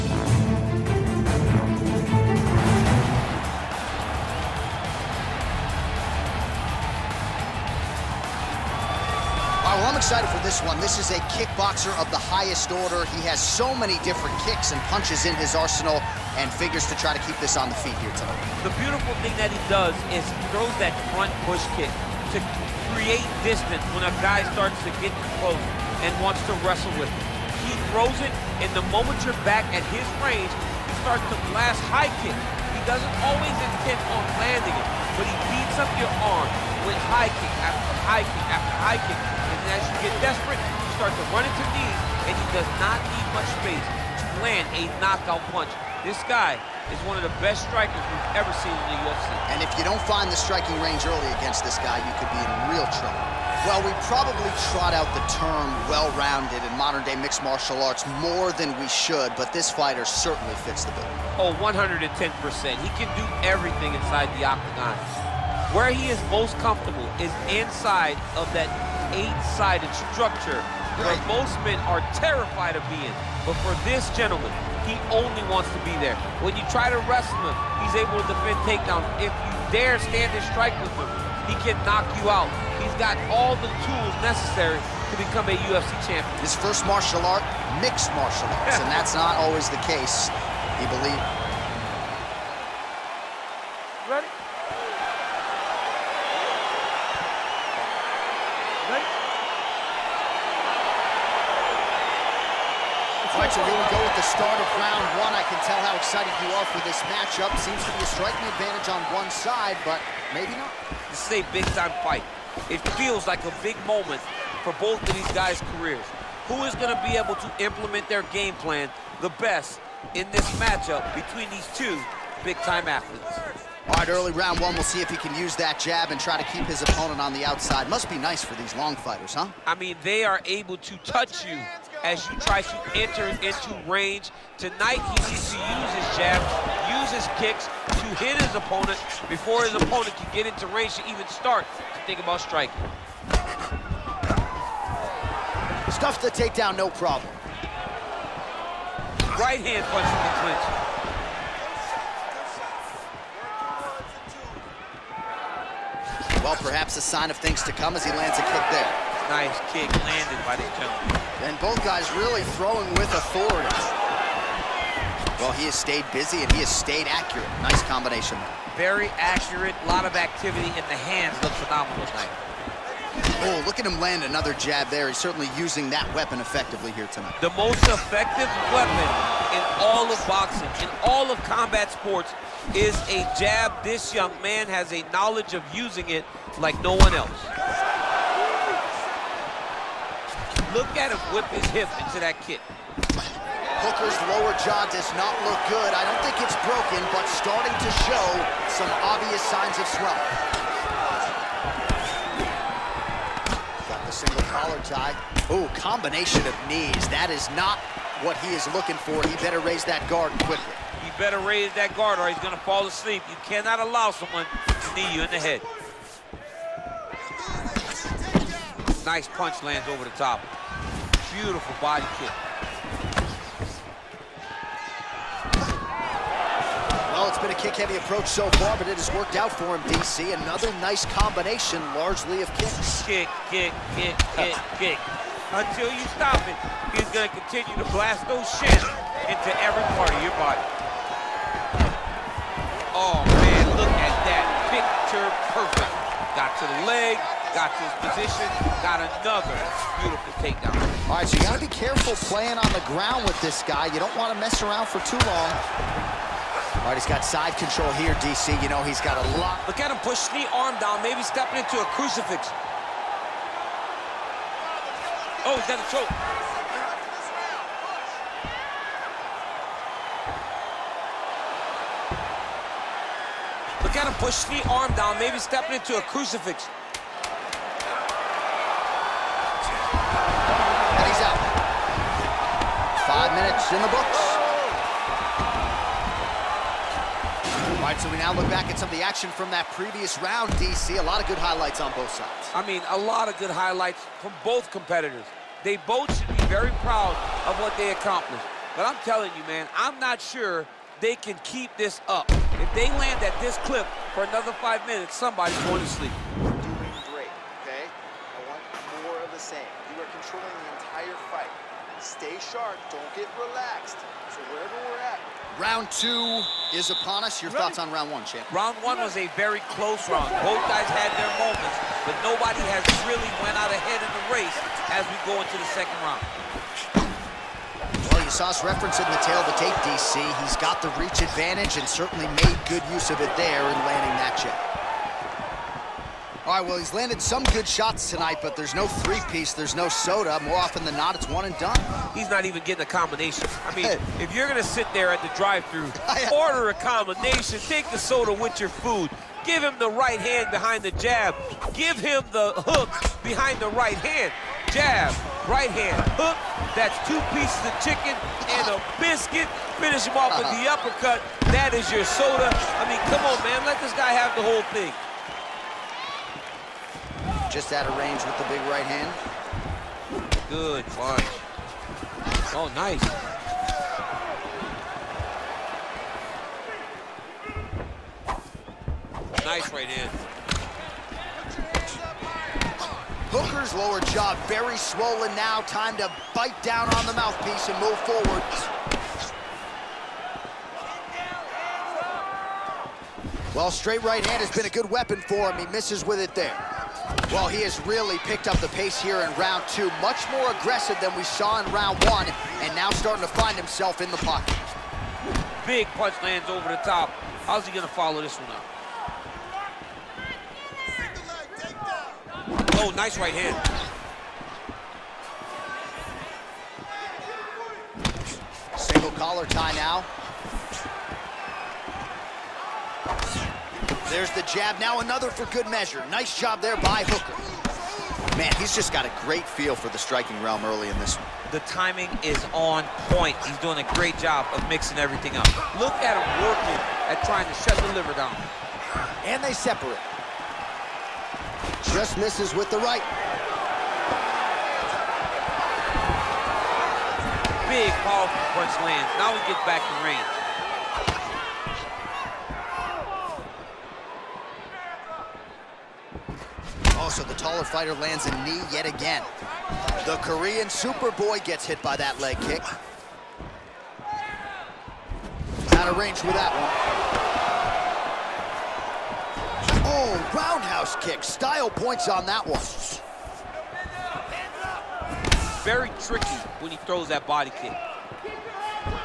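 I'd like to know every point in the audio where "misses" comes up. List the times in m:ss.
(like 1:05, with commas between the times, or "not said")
6:35, 7:22.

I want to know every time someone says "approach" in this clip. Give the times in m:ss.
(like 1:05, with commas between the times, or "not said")
3:47.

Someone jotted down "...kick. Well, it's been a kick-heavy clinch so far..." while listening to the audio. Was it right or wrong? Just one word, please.
wrong.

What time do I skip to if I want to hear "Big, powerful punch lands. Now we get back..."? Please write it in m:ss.
7:27.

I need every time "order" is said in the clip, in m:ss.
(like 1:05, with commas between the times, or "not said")
0:12, 5:46.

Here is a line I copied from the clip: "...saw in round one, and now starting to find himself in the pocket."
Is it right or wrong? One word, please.
right.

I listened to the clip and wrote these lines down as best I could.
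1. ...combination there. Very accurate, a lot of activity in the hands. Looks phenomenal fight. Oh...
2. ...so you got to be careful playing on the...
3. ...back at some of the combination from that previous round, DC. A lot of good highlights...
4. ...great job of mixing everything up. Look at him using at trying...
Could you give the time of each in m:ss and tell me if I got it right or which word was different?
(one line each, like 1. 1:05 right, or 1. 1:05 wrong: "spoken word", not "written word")
1. 2:47 wrong: "tonight", not "fight"
2. 4:11 right
3. 4:48 wrong: "action", not "combination"
4. 7:13 wrong: "working", not "using".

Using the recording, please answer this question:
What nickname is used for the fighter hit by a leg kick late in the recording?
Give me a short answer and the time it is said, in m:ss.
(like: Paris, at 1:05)
The Korean Superboy, at 7:40.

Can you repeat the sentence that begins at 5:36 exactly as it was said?
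All right, well, he's landed some good shots tonight, but there's no three-piece, there's no soda.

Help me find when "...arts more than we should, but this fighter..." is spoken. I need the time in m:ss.
0:57.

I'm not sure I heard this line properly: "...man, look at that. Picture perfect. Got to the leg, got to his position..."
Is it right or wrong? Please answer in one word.
right.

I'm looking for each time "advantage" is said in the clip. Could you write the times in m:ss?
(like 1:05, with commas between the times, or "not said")
1:48, 5:31.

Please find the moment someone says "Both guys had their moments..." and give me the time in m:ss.
5:20.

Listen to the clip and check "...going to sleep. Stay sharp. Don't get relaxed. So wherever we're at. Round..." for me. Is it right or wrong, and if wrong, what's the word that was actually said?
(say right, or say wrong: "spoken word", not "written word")
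right.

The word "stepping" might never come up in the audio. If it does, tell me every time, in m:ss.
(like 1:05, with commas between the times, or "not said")
4:21, 4:35.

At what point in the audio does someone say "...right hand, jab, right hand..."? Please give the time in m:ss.
5:53.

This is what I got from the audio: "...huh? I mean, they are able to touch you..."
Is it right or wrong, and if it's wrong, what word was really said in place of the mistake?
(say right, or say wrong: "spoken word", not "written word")
right.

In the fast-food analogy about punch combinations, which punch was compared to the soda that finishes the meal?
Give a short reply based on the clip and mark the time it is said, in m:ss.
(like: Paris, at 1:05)
The uppercut, at 6:00.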